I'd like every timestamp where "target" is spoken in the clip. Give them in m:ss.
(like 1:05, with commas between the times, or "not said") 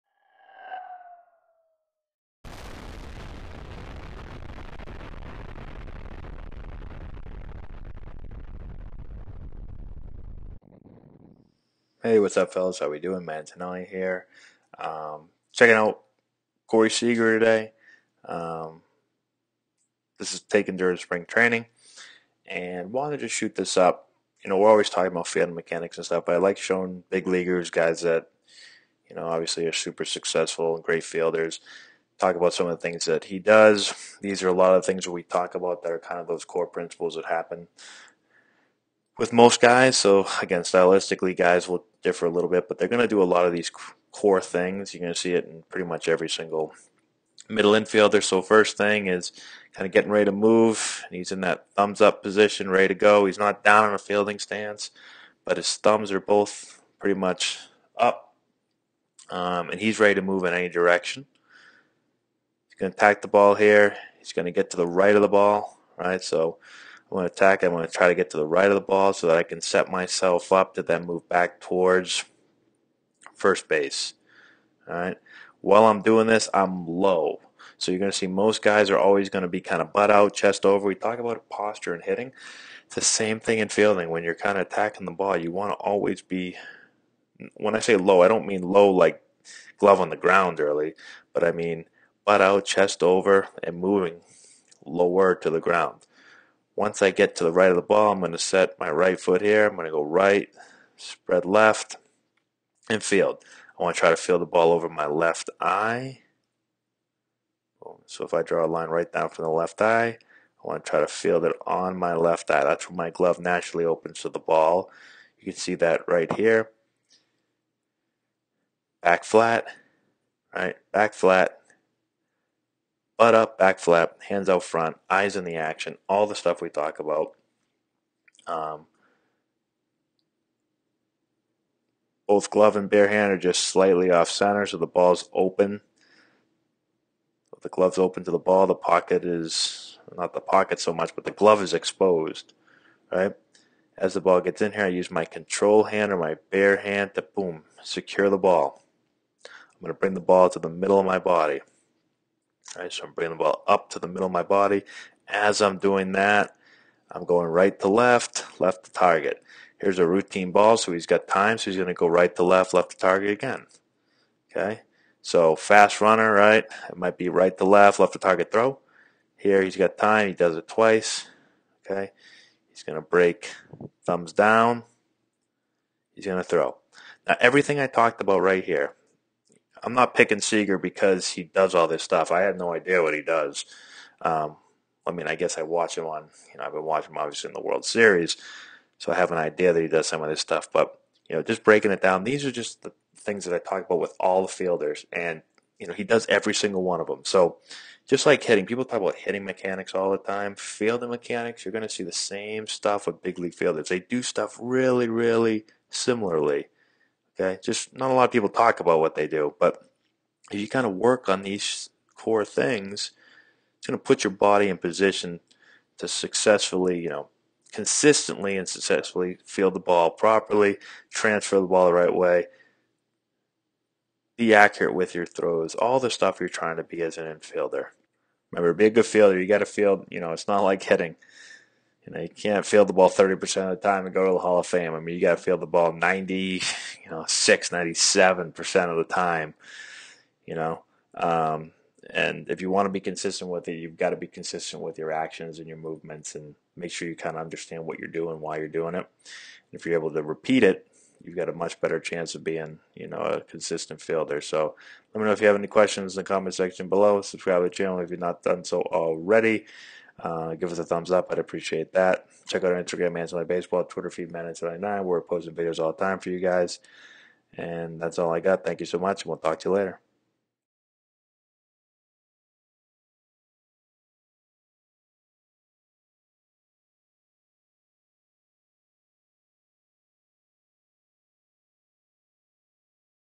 2:38, 2:42, 2:48.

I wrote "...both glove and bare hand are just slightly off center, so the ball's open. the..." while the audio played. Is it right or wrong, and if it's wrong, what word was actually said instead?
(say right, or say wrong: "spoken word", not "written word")
right.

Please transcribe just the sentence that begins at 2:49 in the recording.
Here he's got time, he does it twice.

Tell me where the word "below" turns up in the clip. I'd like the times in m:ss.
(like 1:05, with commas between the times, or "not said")
4:16.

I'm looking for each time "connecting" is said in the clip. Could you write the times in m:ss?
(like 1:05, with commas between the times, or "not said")
not said.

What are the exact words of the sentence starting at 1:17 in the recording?
So you're going to see most guys are always going to be kind of butt out, chest over.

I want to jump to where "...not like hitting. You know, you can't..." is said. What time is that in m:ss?
3:50.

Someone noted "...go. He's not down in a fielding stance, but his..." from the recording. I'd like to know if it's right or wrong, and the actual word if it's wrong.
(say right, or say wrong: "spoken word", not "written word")
right.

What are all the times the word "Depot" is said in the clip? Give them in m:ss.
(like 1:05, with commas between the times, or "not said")
not said.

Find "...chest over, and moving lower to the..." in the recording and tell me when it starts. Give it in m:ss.
1:32.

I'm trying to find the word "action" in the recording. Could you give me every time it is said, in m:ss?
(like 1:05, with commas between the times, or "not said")
2:05, 4:05.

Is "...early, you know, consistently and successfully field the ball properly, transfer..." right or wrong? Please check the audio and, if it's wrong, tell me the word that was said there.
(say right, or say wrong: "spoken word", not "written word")
wrong: "successfully", not "early".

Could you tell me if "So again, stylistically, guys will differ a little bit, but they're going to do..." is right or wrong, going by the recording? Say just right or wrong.
right.